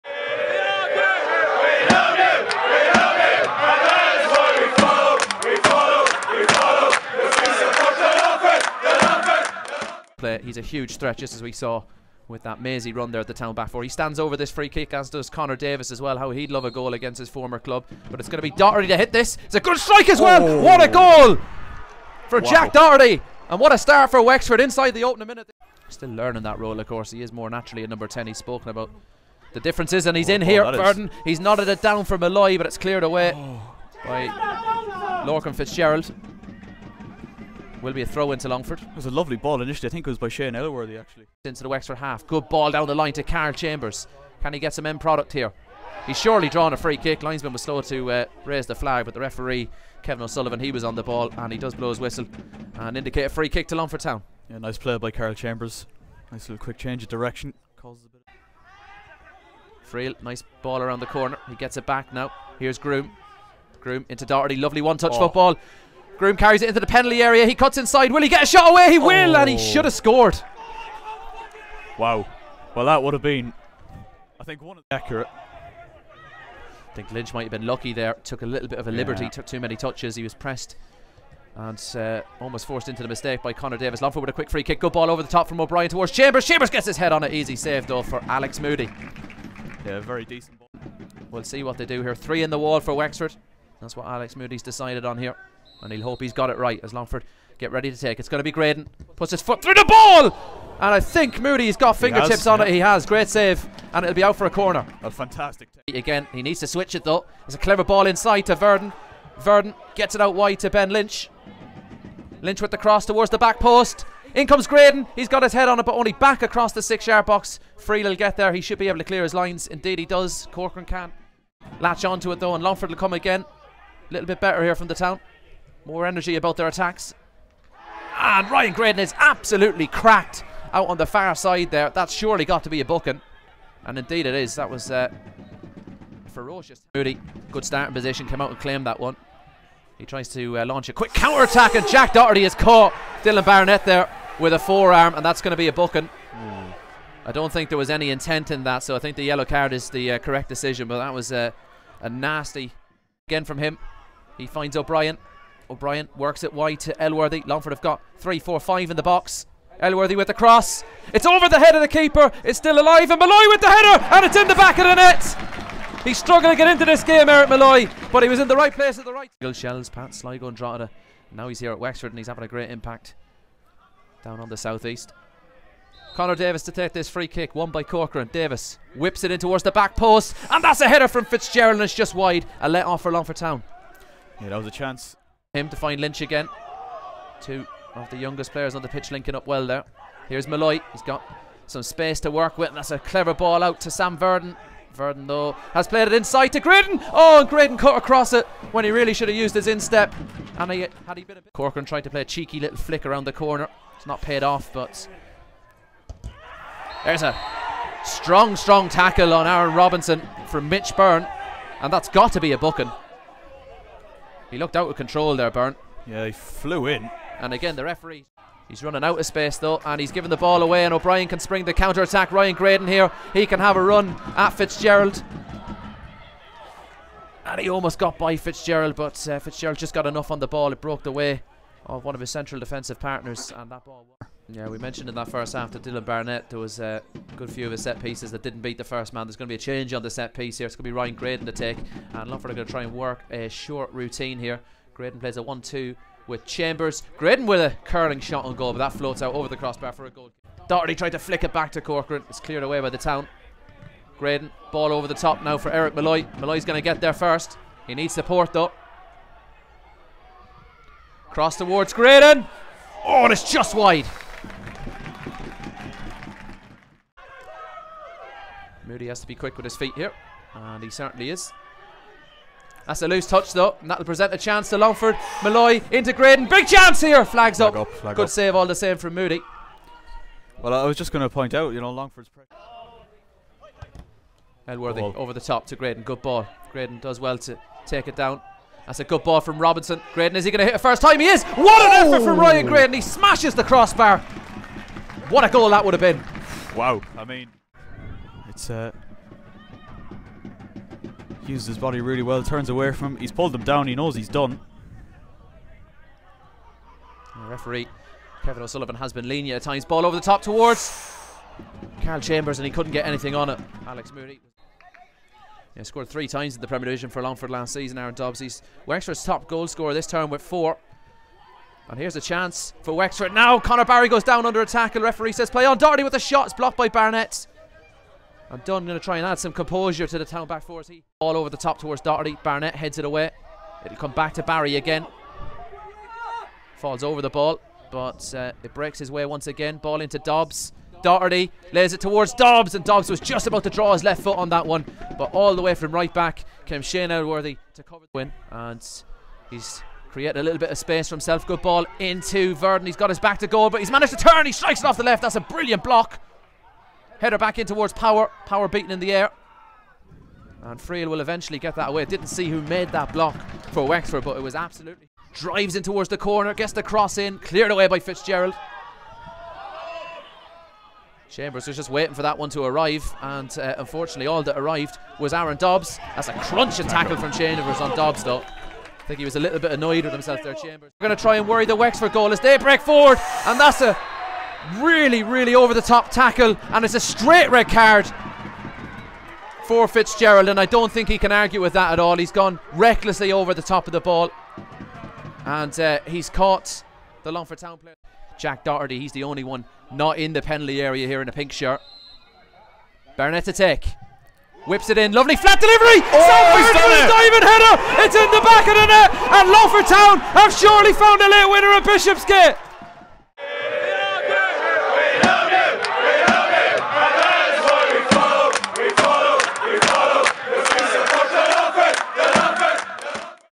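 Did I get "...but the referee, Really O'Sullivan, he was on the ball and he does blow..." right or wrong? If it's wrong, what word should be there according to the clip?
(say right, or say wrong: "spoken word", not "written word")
wrong: "Kevin", not "Really".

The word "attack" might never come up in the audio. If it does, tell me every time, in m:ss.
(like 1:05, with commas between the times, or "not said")
2:06, 2:21, 3:42.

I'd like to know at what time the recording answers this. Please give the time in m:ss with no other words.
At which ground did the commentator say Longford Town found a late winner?
6:51.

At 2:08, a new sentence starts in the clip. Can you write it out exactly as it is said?
And Ryan Graydon is absolutely cracked out on the far side there.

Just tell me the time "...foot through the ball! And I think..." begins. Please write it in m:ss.
1:39.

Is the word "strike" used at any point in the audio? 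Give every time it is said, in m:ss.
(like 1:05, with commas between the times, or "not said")
0:19, 5:54.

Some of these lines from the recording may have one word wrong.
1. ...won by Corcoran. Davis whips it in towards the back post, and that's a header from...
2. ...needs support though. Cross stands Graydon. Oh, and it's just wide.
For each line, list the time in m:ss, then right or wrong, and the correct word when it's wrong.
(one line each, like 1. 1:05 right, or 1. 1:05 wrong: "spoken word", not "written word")
1. 2:57 right
2. 4:17 wrong: "towards", not "stands".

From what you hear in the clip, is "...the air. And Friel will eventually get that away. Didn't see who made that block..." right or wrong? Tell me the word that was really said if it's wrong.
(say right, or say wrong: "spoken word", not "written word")
right.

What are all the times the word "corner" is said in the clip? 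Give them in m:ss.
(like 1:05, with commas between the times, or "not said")
1:01, 1:44, 3:23, 6:06.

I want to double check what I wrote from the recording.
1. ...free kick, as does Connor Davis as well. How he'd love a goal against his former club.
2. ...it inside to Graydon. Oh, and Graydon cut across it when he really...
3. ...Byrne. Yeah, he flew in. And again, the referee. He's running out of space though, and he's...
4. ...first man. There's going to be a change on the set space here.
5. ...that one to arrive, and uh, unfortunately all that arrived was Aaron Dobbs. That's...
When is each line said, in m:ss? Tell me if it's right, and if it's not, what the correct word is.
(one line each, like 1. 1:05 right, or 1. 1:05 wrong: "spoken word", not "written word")
1. 0:14 right
2. 3:16 right
3. 3:35 right
4. 3:58 wrong: "piece", not "space"
5. 6:12 right.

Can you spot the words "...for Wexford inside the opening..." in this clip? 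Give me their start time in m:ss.
0:24.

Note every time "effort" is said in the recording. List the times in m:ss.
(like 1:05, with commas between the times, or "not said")
4:52.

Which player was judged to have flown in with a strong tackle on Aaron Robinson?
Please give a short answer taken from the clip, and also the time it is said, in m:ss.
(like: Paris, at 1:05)
Mitch Byrne, at 3:30.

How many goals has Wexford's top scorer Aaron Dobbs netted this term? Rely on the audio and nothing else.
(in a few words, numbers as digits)
4.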